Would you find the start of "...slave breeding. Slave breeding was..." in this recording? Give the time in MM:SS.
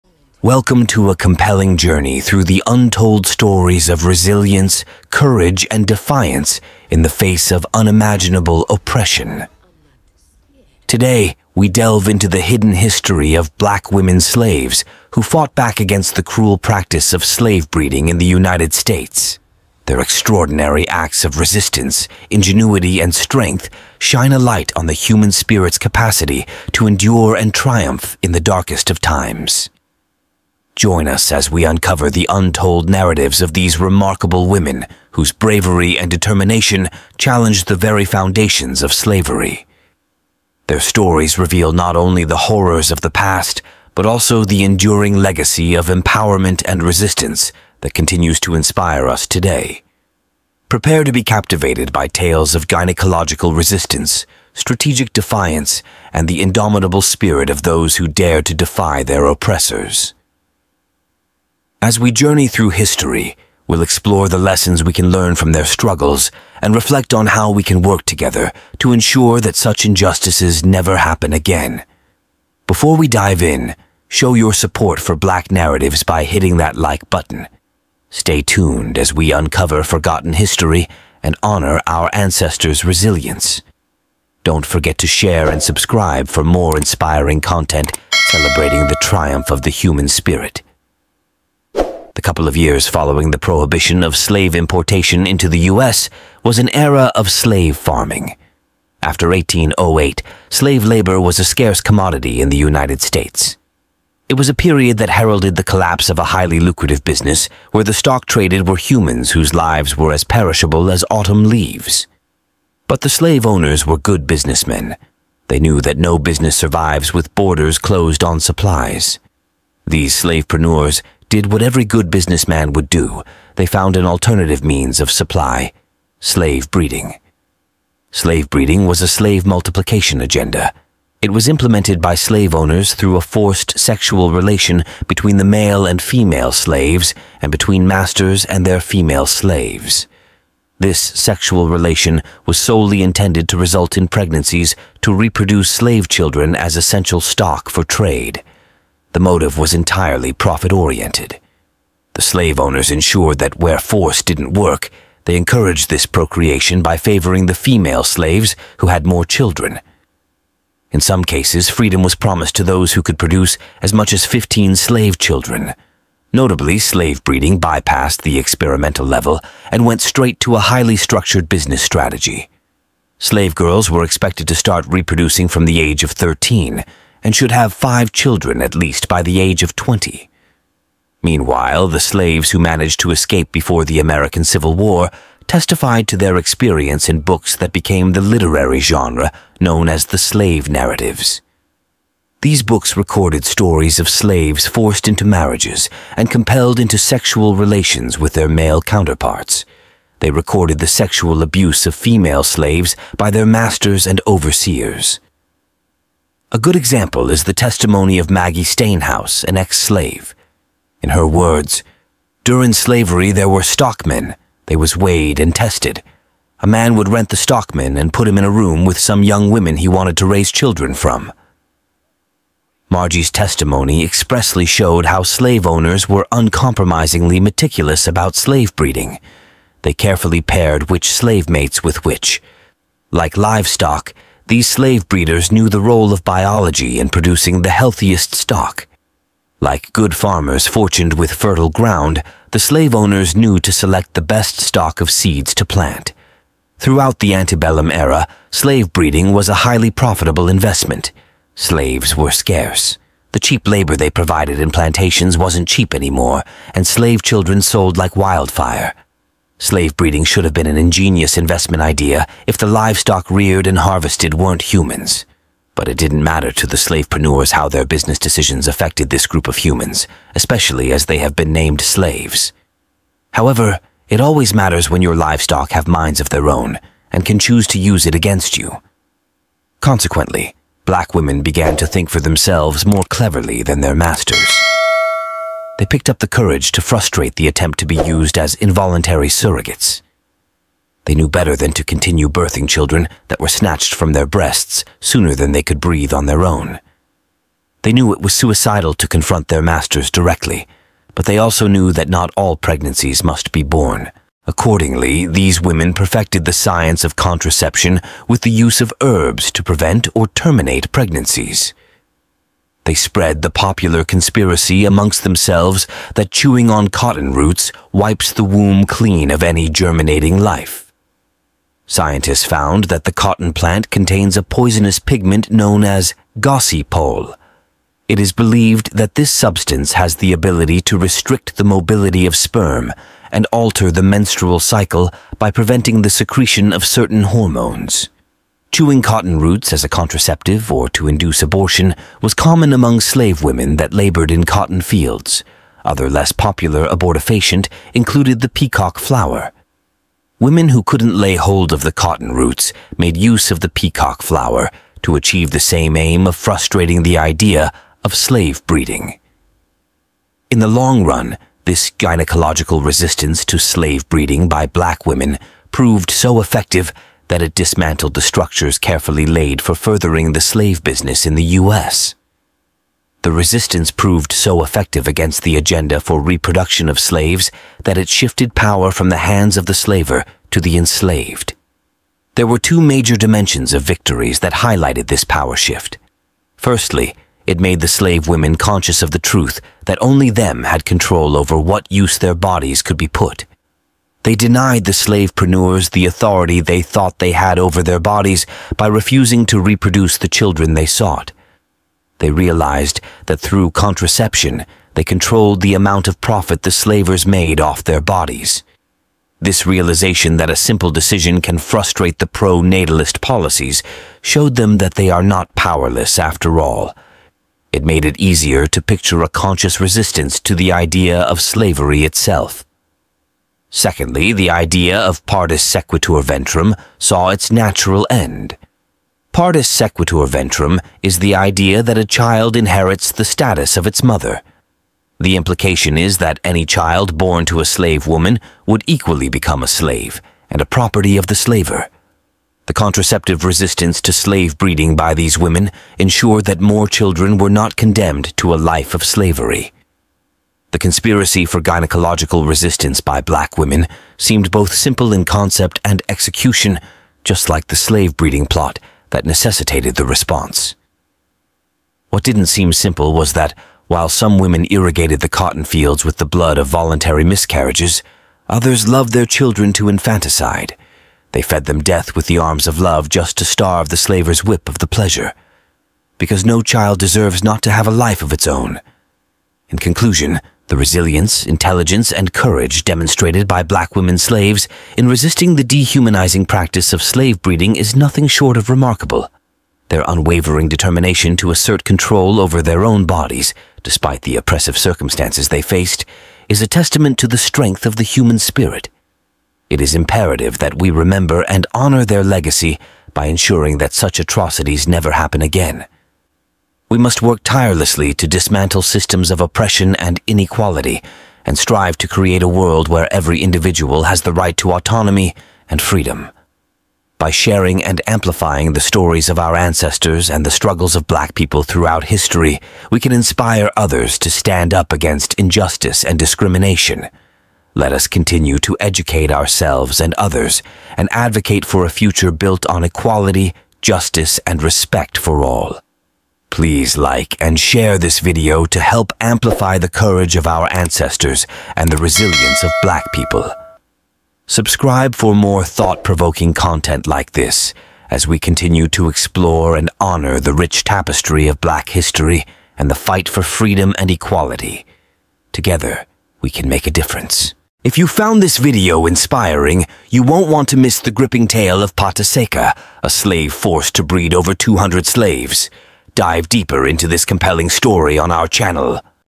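02:06.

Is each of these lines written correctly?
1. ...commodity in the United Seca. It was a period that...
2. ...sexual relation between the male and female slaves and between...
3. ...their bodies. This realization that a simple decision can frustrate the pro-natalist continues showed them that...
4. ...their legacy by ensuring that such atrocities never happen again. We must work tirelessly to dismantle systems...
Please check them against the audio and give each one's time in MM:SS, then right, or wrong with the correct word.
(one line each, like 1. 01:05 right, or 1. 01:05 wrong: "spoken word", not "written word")
1. 01:41 wrong: "States", not "Seca"
2. 02:13 right
3. 06:47 wrong: "policies", not "continues"
4. 08:22 right.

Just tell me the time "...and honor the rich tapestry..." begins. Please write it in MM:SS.
09:09.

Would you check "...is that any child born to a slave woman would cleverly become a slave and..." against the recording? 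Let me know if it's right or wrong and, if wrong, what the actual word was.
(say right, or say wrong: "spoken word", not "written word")
wrong: "equally", not "cleverly".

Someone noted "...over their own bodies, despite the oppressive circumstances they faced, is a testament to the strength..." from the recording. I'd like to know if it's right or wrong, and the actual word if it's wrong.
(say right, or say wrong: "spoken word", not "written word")
right.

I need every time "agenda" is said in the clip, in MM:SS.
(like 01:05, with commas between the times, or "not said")
02:10, 06:15.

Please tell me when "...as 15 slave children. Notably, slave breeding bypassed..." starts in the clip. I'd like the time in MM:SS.
02:44.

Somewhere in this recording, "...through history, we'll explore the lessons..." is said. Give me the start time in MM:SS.
01:02.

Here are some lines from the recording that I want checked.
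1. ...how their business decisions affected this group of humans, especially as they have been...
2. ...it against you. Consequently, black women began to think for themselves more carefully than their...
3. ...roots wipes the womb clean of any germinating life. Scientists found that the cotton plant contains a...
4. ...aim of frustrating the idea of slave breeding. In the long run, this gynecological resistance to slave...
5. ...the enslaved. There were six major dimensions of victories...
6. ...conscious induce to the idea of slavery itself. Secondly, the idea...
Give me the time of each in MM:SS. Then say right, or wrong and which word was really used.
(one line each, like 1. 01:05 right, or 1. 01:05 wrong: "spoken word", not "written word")
1. 04:27 right
2. 04:38 wrong: "cleverly", not "carefully"
3. 05:17 right
4. 05:55 right
5. 06:20 wrong: "two", not "six"
6. 06:59 wrong: "resistance", not "induce".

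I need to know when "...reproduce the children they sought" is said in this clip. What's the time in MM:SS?
06:39.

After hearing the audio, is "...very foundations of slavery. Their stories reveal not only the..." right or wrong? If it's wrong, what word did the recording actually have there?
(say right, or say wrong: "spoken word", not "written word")
right.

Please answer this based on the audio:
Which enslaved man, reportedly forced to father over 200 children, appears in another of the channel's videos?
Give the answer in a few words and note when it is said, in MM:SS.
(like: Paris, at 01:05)
Pata Seca, at 09:21.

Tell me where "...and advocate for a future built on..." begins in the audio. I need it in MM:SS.
08:50.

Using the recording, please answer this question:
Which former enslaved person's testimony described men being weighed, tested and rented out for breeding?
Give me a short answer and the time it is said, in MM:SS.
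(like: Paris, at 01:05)
Maggie Stenhouse, at 03:28.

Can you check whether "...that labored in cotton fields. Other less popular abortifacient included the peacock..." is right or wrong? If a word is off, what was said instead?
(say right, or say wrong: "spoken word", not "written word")
right.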